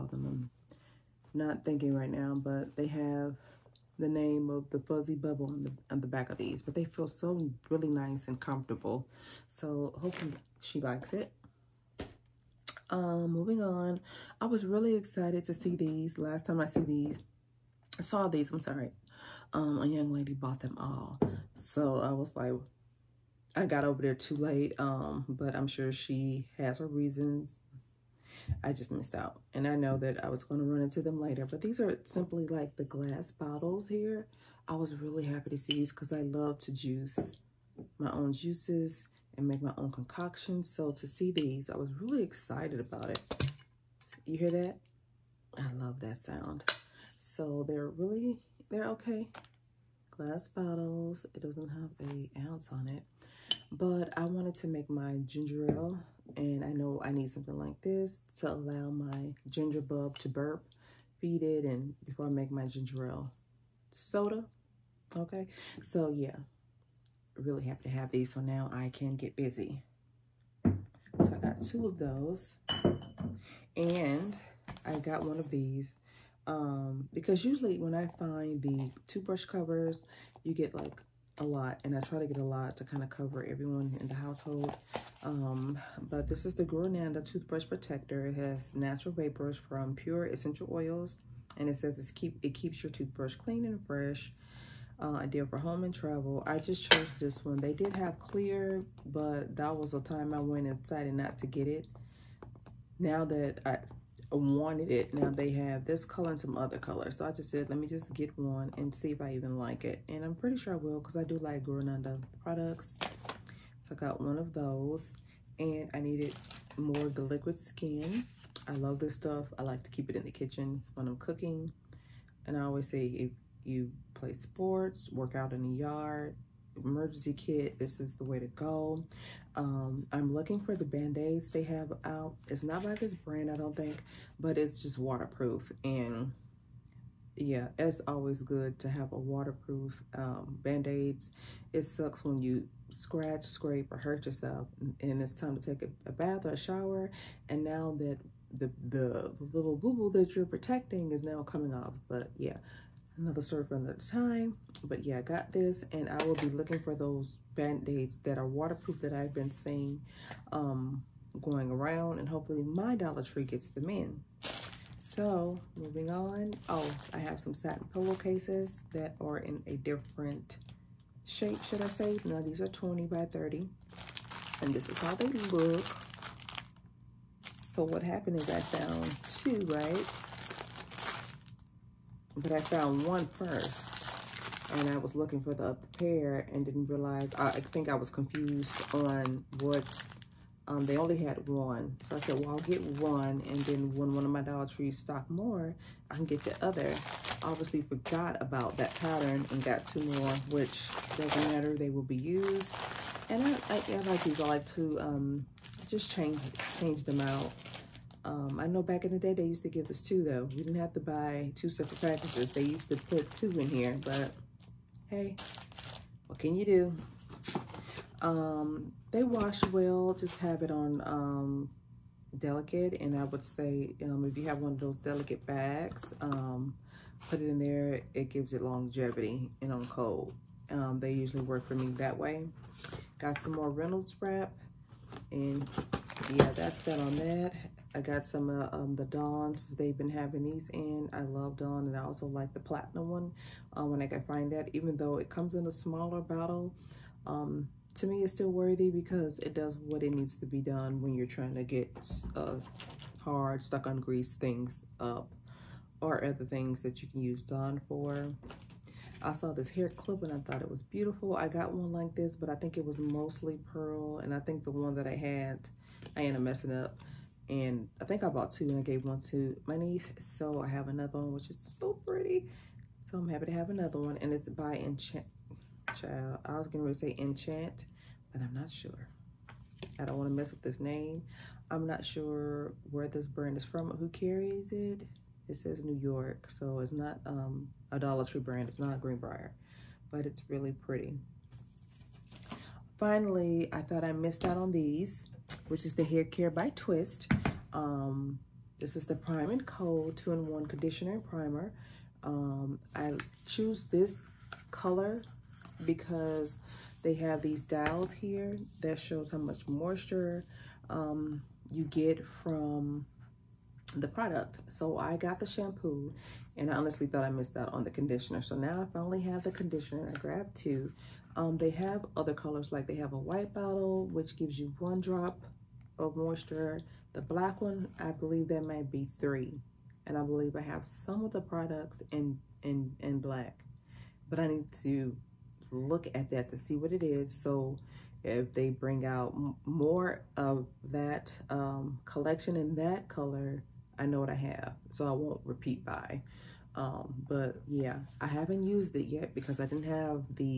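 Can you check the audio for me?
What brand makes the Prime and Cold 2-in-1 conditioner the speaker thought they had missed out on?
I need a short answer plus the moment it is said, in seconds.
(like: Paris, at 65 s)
Twist, at 296 s.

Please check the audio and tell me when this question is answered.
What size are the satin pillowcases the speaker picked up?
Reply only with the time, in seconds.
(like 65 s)
172 s.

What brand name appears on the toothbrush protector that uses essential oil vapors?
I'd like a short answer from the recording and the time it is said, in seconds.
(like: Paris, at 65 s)
Guru, at 86 s.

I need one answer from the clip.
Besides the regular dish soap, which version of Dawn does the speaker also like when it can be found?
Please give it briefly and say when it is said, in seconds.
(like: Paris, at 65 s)
Platinum, at 242 s.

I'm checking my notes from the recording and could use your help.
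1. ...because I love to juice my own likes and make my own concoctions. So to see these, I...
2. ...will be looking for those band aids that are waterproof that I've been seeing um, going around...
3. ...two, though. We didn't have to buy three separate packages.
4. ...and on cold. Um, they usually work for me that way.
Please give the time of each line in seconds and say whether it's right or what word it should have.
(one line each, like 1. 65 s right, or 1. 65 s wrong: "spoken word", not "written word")
1. 35 s wrong: "juices", not "likes"
2. 156 s right
3. 209 s wrong: "two", not "three"
4. 229 s right.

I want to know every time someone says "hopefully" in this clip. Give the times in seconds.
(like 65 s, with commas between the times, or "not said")
9 s, 162 s.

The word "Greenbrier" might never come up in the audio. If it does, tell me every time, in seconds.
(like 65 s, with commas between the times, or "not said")
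288 s.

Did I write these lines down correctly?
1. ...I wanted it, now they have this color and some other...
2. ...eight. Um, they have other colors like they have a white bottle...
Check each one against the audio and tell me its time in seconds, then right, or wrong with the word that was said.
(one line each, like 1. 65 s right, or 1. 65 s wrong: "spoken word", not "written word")
1. 103 s right
2. 320 s wrong: "two", not "eight".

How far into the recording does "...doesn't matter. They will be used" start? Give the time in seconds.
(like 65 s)
201 s.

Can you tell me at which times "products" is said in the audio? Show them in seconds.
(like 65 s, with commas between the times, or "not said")
112 s, 314 s, 331 s.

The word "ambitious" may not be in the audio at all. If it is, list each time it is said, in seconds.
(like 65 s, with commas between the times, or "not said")
not said.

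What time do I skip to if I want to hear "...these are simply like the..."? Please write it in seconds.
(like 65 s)
31 s.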